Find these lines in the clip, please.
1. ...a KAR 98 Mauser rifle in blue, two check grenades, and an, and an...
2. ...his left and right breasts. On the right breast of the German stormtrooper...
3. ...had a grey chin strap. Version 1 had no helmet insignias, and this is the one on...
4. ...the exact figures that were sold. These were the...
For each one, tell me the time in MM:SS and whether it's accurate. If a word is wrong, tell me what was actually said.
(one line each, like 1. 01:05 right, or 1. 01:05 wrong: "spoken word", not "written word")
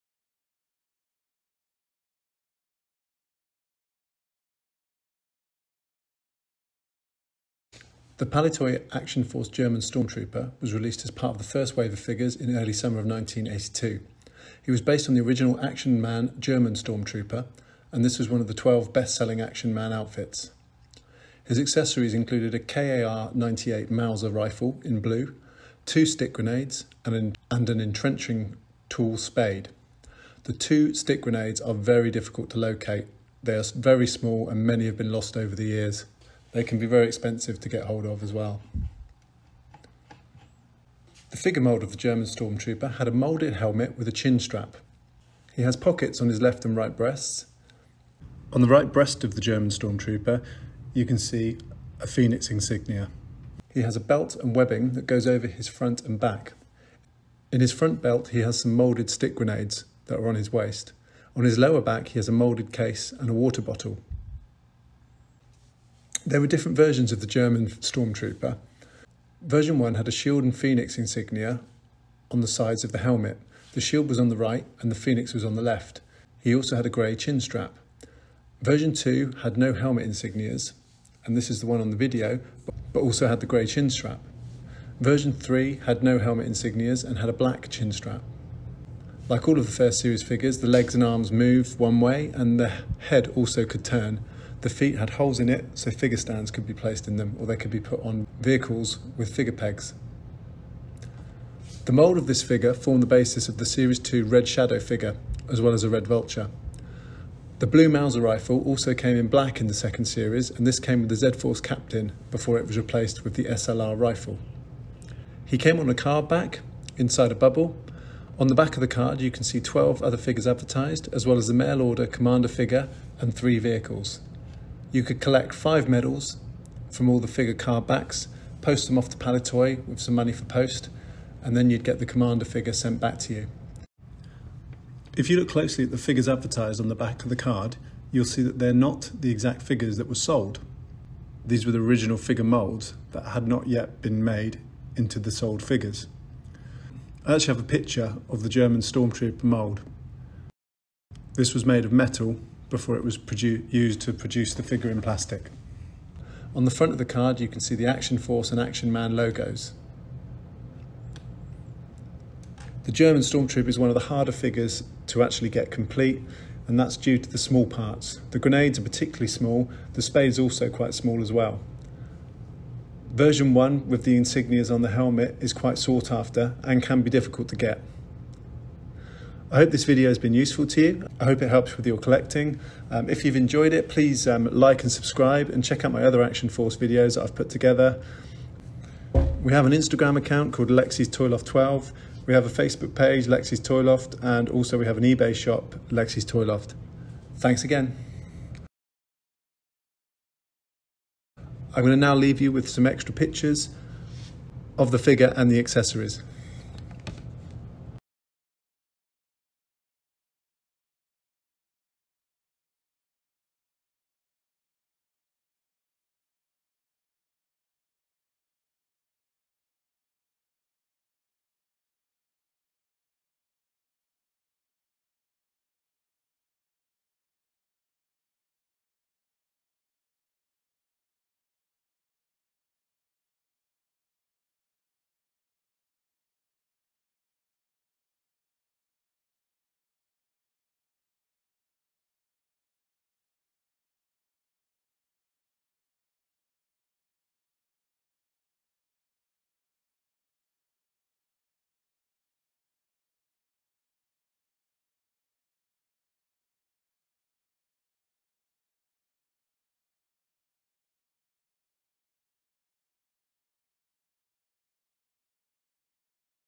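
1. 00:22 wrong: "stick", not "check"
2. 00:46 right
3. 01:16 wrong: "2", not "1"
4. 02:19 right.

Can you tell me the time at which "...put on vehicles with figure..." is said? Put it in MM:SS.
01:37.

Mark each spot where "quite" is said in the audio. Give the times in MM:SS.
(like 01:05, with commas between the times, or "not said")
02:50, 02:55.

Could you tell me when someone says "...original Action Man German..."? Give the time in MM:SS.
00:15.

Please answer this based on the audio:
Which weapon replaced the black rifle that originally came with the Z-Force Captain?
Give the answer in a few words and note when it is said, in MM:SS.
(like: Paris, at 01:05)
SLR rifle, at 01:53.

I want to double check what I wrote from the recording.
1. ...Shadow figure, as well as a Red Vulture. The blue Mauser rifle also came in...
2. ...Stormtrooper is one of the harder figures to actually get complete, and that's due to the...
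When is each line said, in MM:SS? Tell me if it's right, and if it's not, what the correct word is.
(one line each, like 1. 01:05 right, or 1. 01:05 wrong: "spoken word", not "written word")
1. 01:44 right
2. 02:43 right.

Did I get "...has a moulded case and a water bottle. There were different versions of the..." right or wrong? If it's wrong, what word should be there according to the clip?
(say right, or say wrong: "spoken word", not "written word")
right.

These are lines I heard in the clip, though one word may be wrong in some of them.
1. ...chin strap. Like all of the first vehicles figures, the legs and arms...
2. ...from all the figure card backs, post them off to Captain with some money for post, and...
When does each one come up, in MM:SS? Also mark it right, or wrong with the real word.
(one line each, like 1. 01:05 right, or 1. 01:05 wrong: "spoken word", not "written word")
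1. 01:27 wrong: "series", not "vehicles"
2. 02:06 wrong: "Palitoy", not "Captain".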